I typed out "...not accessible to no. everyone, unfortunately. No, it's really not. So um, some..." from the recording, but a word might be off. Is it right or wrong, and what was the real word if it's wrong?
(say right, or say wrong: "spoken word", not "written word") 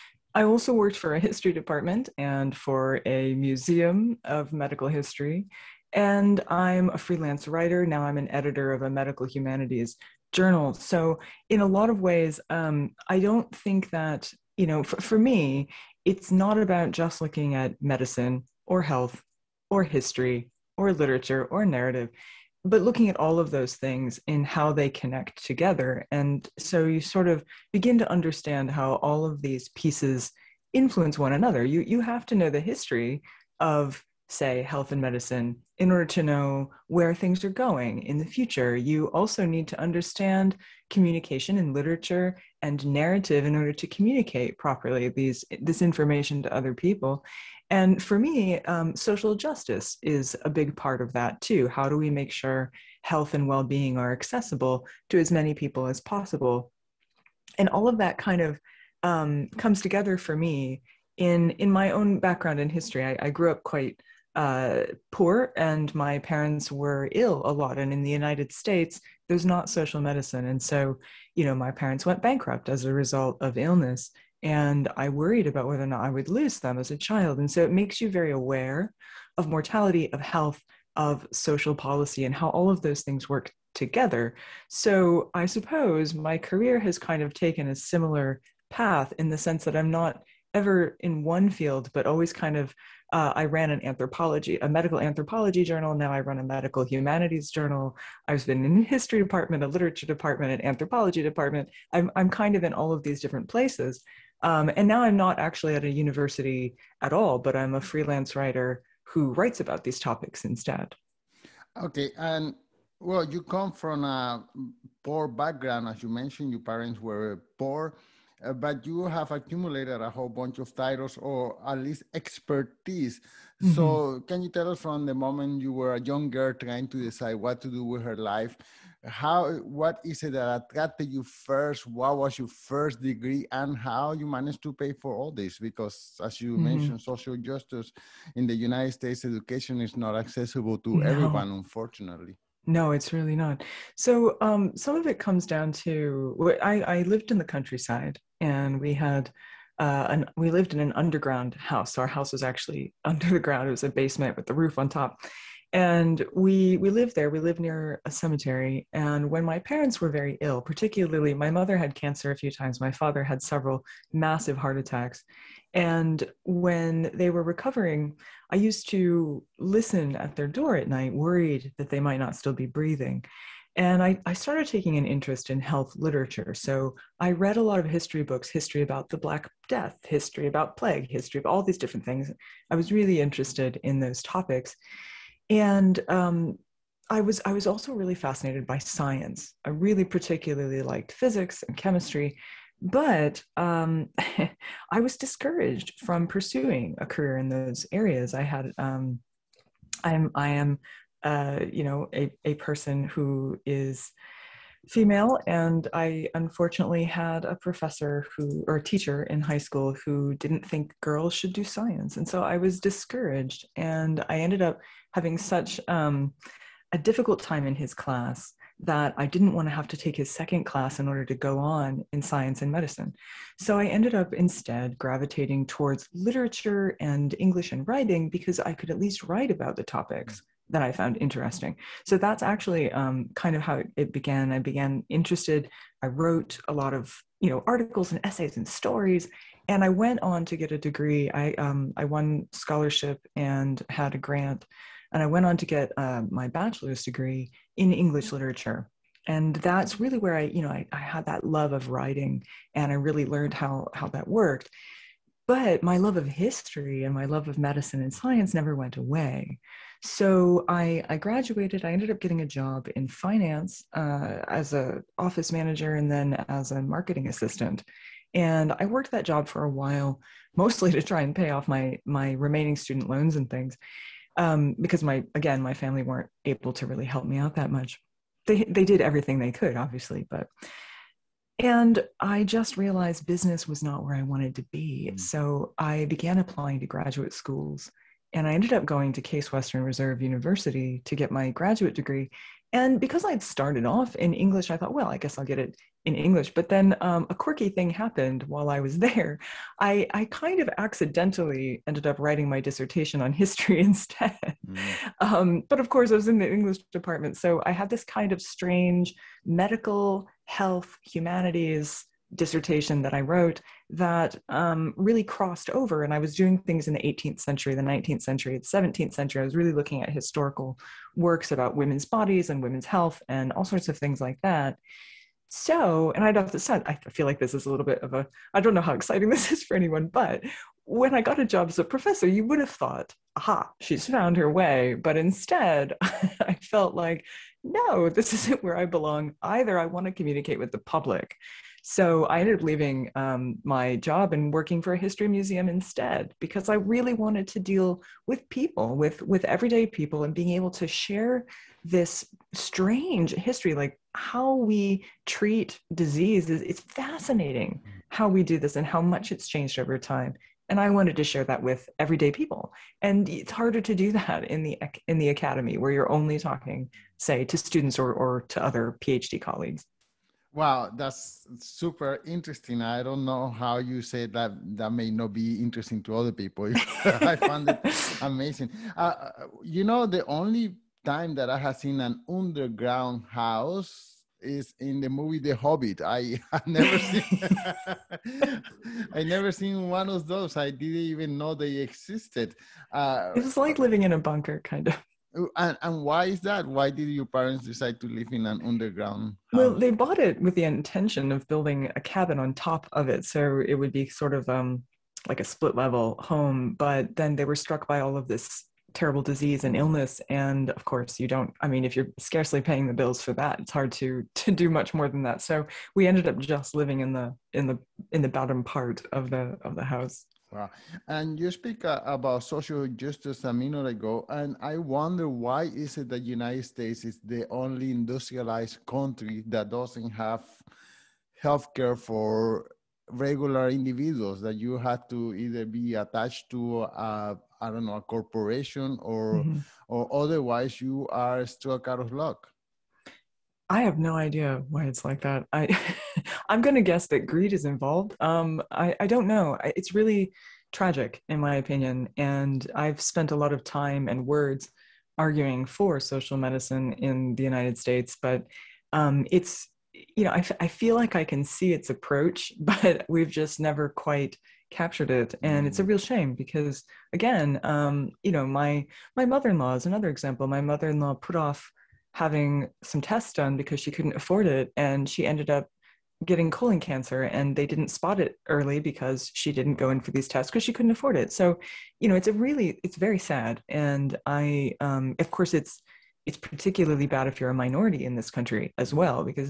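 right.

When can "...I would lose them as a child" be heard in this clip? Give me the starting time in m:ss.
1:16.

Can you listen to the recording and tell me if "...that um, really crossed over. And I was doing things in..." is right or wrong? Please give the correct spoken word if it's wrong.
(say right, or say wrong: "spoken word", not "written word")
right.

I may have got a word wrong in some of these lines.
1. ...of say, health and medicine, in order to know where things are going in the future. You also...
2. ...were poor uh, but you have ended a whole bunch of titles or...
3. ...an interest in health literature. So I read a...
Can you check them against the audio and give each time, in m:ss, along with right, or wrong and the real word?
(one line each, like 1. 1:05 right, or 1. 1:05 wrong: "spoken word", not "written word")
1. 0:33 right
2. 1:56 wrong: "accumulated", not "ended"
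3. 2:54 right.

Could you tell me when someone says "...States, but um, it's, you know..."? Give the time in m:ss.
7:37.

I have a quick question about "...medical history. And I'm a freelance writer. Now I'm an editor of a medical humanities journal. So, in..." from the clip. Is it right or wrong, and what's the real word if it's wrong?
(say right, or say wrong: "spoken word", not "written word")
right.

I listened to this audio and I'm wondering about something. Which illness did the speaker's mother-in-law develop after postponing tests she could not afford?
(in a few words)
Colon cancer.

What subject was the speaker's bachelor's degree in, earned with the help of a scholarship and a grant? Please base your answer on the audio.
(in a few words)
English literature.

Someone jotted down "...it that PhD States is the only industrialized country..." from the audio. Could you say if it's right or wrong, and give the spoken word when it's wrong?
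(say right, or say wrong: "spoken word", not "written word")
wrong: "United", not "PhD".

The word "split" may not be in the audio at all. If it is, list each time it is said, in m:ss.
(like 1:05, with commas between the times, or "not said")
6:45.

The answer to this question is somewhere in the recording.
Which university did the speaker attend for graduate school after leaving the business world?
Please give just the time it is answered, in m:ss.
4:49.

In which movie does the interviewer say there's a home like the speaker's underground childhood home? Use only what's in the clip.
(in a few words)
The Hobbit.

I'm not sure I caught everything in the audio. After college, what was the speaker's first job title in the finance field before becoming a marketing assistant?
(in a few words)
Office manager.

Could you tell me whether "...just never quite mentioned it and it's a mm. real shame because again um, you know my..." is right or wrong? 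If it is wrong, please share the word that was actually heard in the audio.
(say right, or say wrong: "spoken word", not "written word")
wrong: "captured", not "mentioned".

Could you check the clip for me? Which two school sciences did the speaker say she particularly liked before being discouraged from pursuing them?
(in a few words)
Physics and chemistry.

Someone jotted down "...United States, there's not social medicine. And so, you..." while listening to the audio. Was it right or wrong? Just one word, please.
right.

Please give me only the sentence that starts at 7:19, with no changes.
or otherwise you are struck out of luck.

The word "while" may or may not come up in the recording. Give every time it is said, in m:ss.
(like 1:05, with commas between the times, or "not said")
4:29, 4:58.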